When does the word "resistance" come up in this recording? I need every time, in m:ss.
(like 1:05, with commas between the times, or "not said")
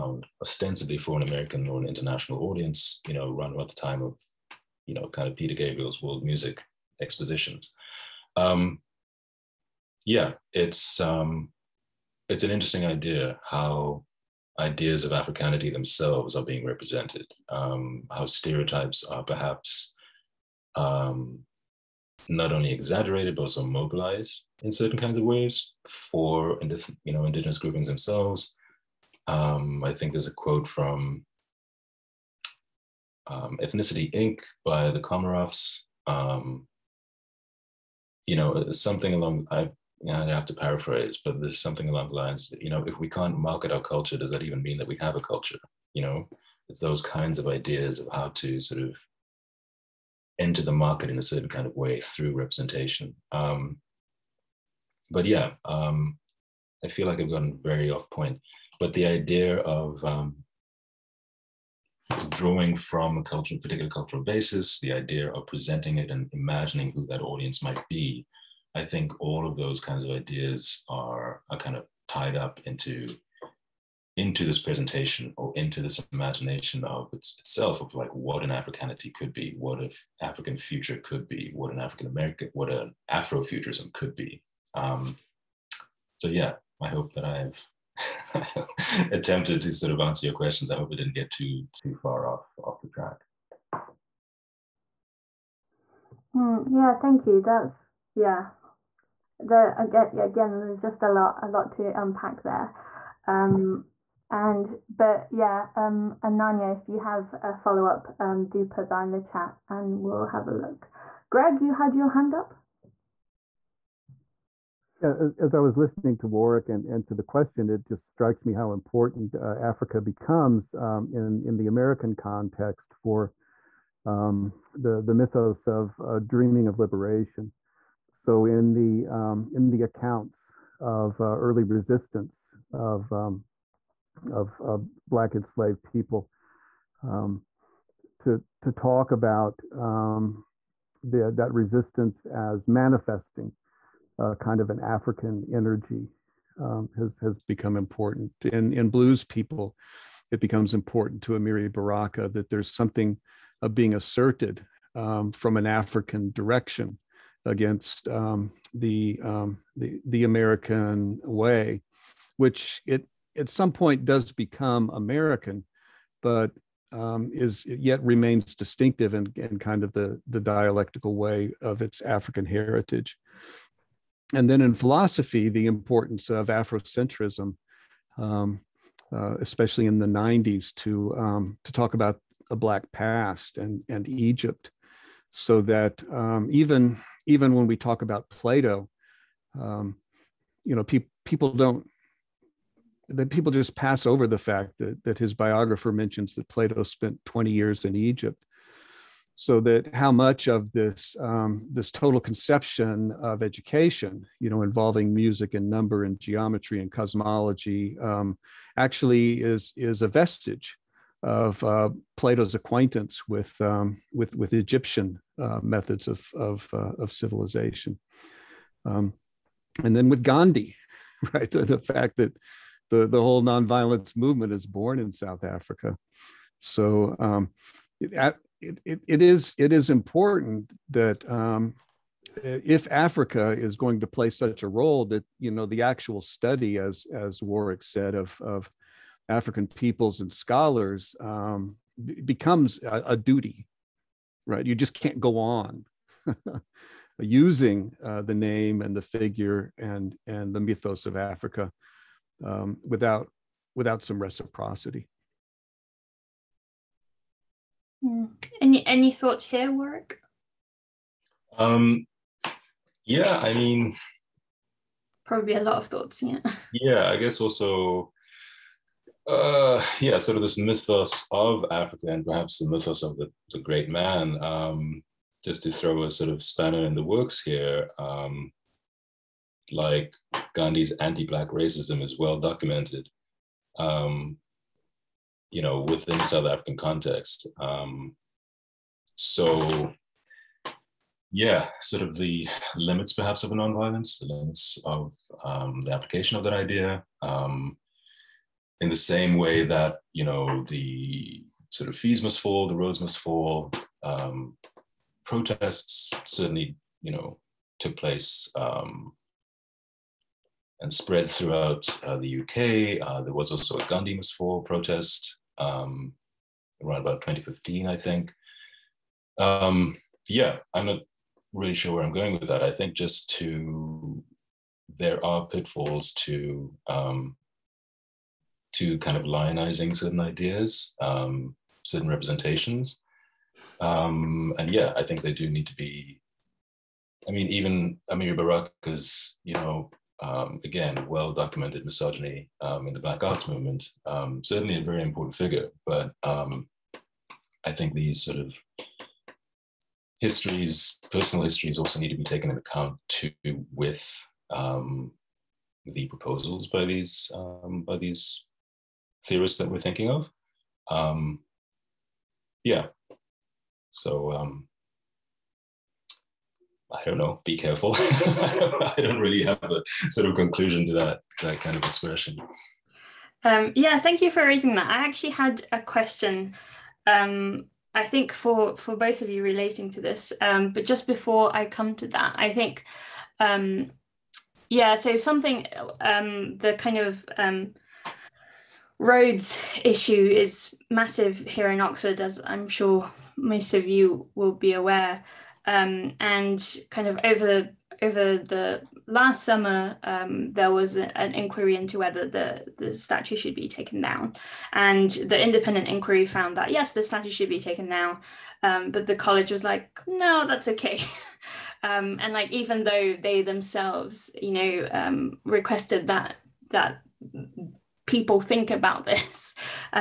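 2:11, 2:21.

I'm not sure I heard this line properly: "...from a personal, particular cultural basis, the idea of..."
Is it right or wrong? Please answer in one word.
wrong.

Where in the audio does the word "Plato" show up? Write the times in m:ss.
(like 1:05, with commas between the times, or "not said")
3:08, 3:16, 3:32.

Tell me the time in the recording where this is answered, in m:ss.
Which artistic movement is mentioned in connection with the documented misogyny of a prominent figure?
5:43.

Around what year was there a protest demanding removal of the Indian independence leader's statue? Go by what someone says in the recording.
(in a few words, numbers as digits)
2015.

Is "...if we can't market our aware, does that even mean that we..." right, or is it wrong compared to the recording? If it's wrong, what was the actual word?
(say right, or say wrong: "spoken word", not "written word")
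wrong: "culture", not "aware".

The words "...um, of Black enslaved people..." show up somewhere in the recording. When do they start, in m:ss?
2:13.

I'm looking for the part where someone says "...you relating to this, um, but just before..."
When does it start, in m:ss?
6:19.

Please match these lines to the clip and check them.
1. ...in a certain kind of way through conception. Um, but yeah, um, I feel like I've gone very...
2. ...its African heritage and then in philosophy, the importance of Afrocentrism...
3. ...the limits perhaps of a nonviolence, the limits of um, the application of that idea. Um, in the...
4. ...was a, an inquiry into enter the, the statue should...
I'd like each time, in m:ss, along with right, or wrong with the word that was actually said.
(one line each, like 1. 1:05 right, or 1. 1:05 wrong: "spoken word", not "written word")
1. 0:51 wrong: "representation", not "conception"
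2. 2:51 right
3. 4:52 right
4. 6:40 wrong: "whether", not "enter".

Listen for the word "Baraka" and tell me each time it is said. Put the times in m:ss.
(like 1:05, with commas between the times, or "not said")
2:31, 5:38.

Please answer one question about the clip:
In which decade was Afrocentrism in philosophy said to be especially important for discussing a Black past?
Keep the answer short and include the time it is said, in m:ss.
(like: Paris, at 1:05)
1990s, at 2:59.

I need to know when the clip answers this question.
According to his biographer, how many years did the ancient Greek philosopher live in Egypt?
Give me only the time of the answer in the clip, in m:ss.
3:17.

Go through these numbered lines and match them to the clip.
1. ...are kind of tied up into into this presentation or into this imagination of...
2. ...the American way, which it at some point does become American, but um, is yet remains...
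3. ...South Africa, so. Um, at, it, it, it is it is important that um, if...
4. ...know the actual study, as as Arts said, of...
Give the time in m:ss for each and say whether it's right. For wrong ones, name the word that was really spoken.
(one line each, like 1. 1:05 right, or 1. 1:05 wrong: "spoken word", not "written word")
1. 1:11 right
2. 2:40 right
3. 3:45 right
4. 3:55 wrong: "Warrick", not "Arts".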